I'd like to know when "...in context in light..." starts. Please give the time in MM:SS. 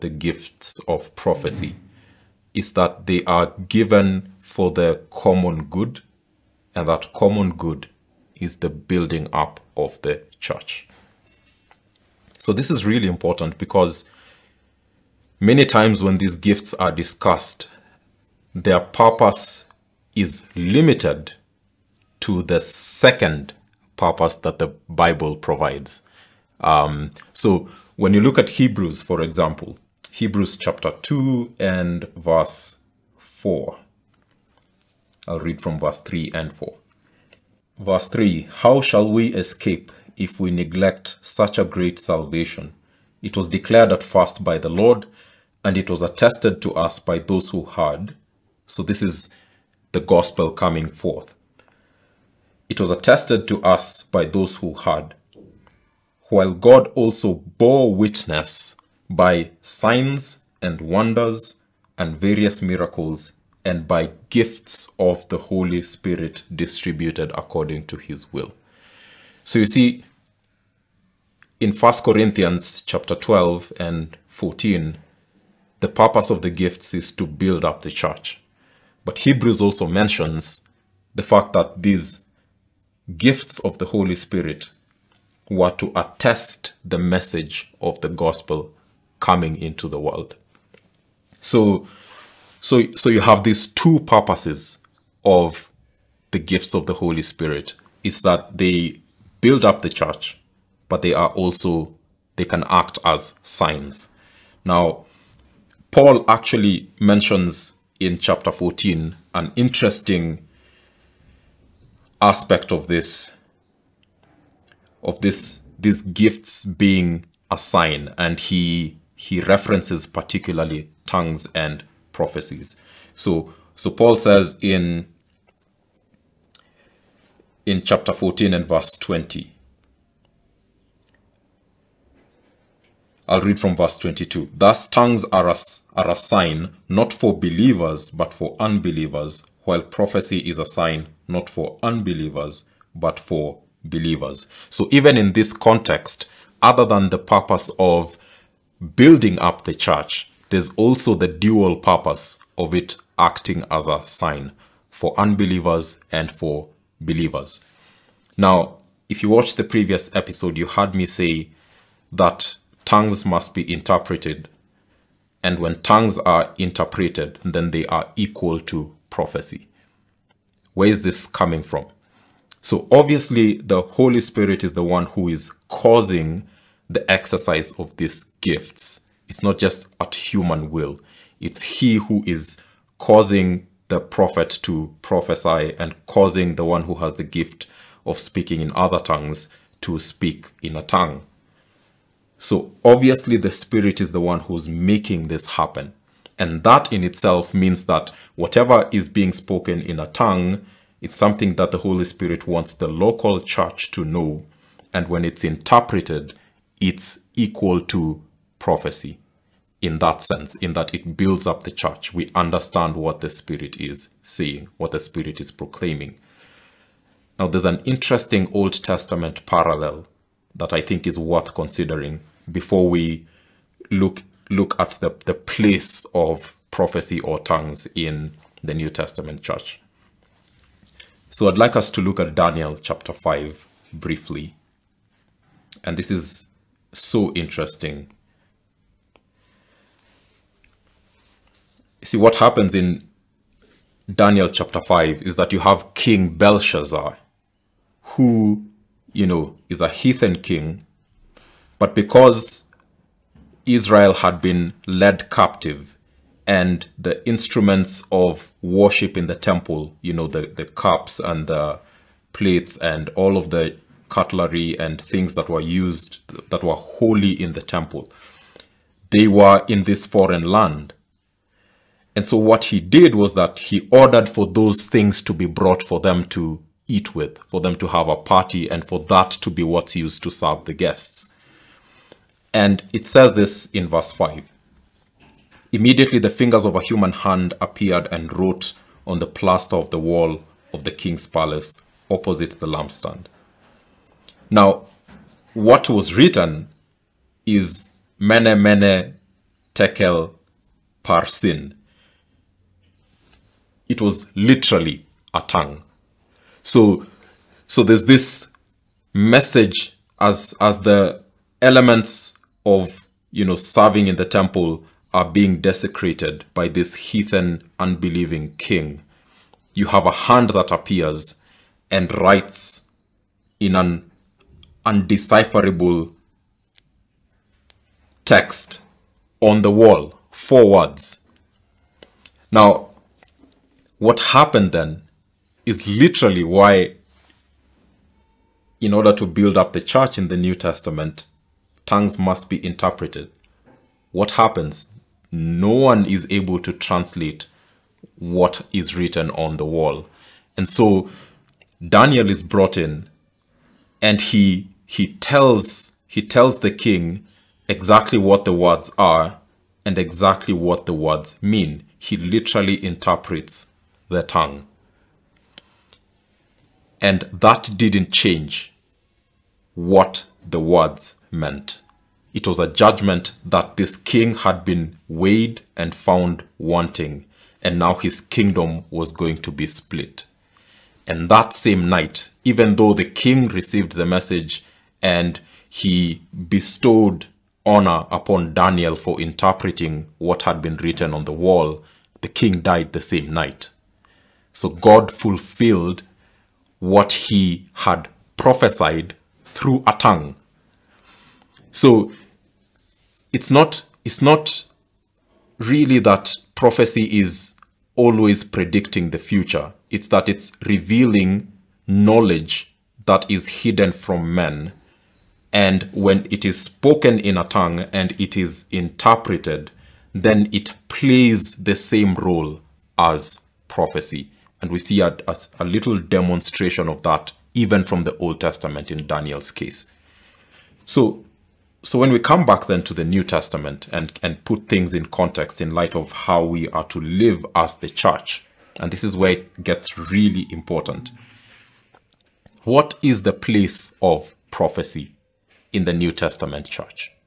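07:14.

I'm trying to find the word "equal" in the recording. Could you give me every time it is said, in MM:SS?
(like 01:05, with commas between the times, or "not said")
02:48, 03:27.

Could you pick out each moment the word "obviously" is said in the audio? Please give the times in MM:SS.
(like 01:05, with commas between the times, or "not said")
02:52, 03:12.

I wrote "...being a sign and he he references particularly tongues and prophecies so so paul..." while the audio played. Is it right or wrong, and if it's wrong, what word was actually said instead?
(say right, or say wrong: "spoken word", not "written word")
right.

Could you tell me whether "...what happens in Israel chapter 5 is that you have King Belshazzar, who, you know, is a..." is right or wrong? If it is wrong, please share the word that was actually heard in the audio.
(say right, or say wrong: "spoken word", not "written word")
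wrong: "Daniel", not "Israel".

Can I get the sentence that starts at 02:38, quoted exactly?
Now, if you watched the previous episode, you heard me say that tongues must be interpreted.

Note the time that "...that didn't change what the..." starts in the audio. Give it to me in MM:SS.
06:07.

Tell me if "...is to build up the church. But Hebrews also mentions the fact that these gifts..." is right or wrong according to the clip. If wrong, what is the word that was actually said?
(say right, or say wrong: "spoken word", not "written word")
right.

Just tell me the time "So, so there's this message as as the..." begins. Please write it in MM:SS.
05:06.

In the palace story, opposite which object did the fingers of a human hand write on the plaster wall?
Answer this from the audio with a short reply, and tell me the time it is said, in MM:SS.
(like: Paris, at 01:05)
the lampstand, at 04:52.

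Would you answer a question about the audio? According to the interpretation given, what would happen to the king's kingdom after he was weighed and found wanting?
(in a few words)
split.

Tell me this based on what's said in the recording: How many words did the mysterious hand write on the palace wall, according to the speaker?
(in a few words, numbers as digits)
4.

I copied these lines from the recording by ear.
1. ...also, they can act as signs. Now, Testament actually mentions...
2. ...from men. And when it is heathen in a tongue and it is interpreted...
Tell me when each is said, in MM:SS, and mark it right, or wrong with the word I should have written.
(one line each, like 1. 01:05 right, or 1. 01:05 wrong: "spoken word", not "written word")
1. 01:41 wrong: "Paul", not "Testament"
2. 06:53 wrong: "spoken", not "heathen".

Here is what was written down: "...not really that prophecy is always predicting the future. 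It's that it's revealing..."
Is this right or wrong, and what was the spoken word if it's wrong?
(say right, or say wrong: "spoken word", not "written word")
right.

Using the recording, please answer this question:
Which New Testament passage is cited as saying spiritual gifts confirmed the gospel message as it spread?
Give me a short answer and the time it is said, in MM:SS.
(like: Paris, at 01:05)
Hebrews chapter 2, at 00:30.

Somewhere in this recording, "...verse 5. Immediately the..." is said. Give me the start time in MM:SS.
04:43.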